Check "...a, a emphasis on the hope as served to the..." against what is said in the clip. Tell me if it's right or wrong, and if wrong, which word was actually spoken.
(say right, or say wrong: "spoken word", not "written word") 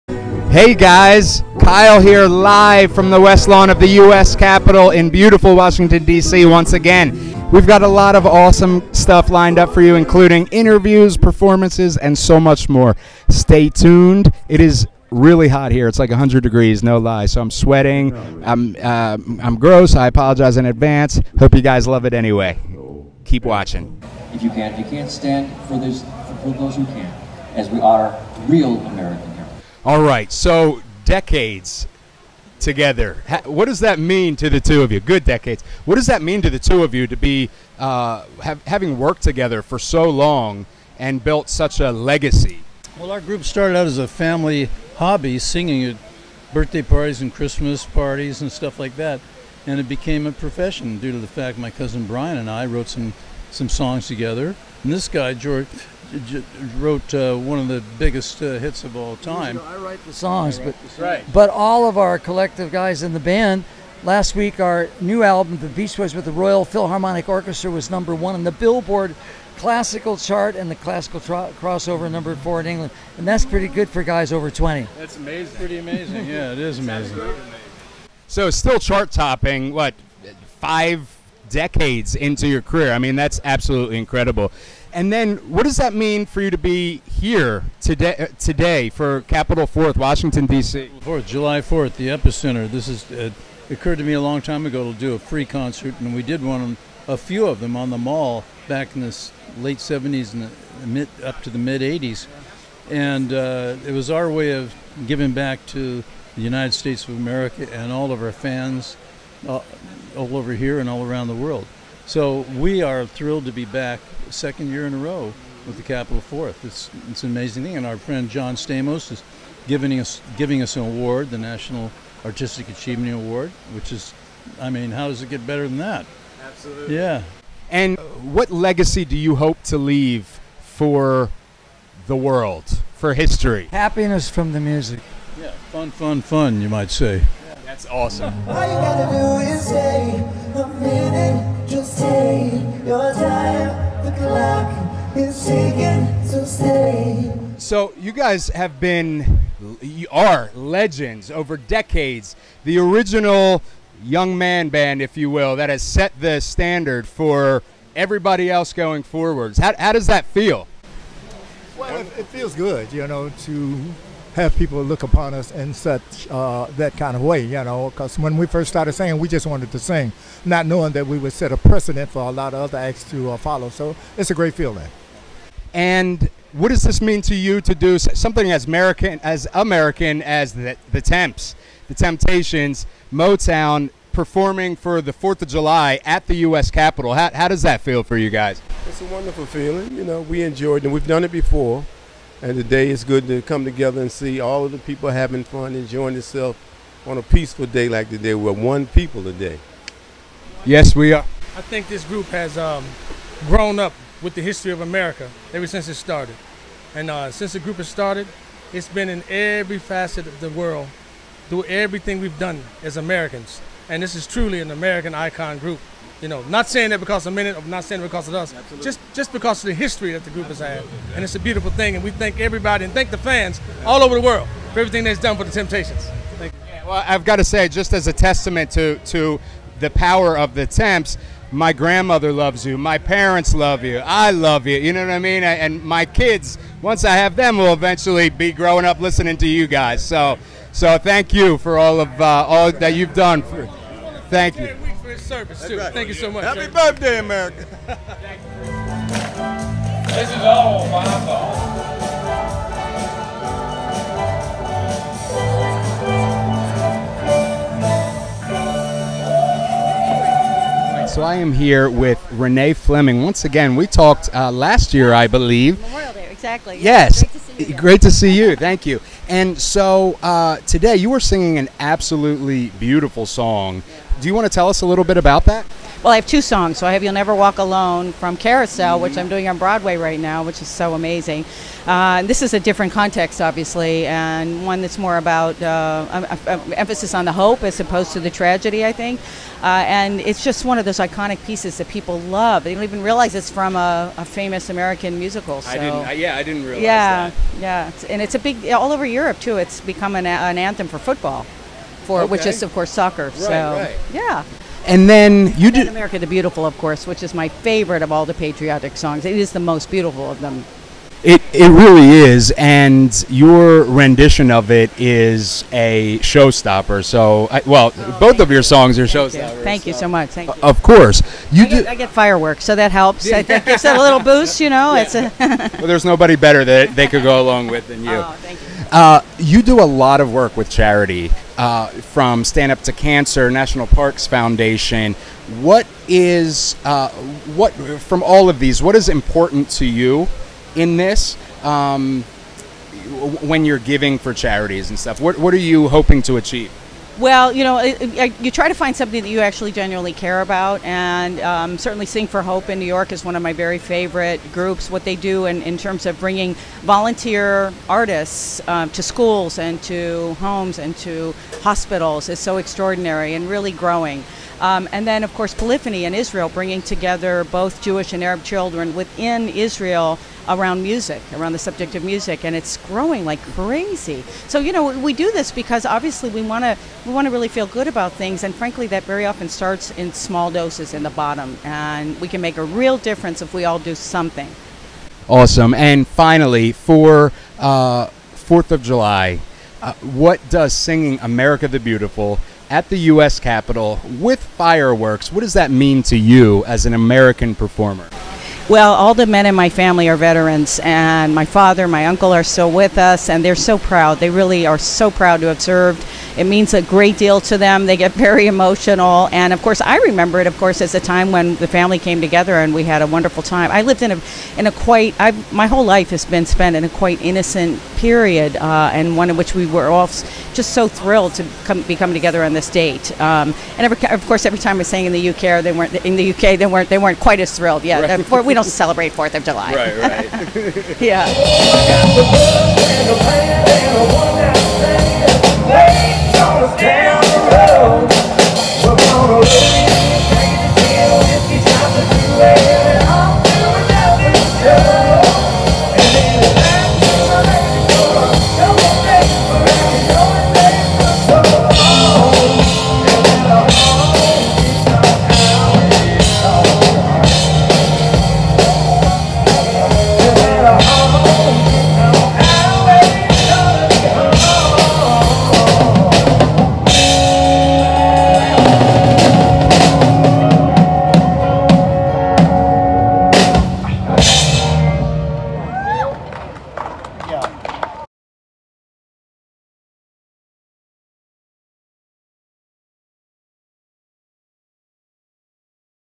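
wrong: "opposed", not "served".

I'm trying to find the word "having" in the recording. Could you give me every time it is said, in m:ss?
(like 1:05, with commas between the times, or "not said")
0:38, 3:15.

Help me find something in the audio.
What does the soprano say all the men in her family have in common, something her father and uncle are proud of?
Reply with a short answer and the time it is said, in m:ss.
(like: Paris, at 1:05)
Veterans, at 6:40.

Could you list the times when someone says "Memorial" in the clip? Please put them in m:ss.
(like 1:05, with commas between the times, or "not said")
4:25.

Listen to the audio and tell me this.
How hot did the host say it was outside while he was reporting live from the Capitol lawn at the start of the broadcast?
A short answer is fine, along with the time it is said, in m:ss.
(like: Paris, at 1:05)
100 degrees, at 0:16.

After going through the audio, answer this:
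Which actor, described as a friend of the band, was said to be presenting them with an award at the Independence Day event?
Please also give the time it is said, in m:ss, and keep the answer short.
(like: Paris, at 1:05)
John Stamos, at 1:58.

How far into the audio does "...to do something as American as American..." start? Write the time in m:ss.
2:57.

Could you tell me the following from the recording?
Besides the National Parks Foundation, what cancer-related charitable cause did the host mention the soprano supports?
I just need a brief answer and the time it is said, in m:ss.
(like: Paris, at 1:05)
Stand Up to Cancer, at 5:32.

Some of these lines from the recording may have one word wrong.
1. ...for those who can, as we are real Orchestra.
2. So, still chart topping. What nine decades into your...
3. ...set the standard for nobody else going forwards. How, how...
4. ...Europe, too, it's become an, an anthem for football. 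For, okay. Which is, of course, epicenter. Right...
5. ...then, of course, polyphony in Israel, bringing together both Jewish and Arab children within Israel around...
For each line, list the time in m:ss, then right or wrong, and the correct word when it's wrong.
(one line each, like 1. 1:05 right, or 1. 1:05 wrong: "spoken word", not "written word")
1. 0:26 wrong: "Americans", not "Orchestra"
2. 1:18 wrong: "five", not "nine"
3. 2:35 wrong: "everybody", not "nobody"
4. 4:59 wrong: "soccer", not "epicenter"
5. 6:05 right.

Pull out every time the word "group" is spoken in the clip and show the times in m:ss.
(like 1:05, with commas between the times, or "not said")
0:43, 3:22, 3:27, 3:35, 3:40, 5:54.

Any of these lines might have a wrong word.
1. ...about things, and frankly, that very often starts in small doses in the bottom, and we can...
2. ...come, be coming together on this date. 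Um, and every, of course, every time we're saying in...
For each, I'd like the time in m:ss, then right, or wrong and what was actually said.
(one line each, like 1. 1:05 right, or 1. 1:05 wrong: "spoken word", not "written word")
1. 6:17 right
2. 7:01 right.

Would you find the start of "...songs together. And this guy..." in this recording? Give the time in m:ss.
0:53.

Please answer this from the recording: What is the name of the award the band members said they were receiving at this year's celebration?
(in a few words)
National Artistic Achievement Award.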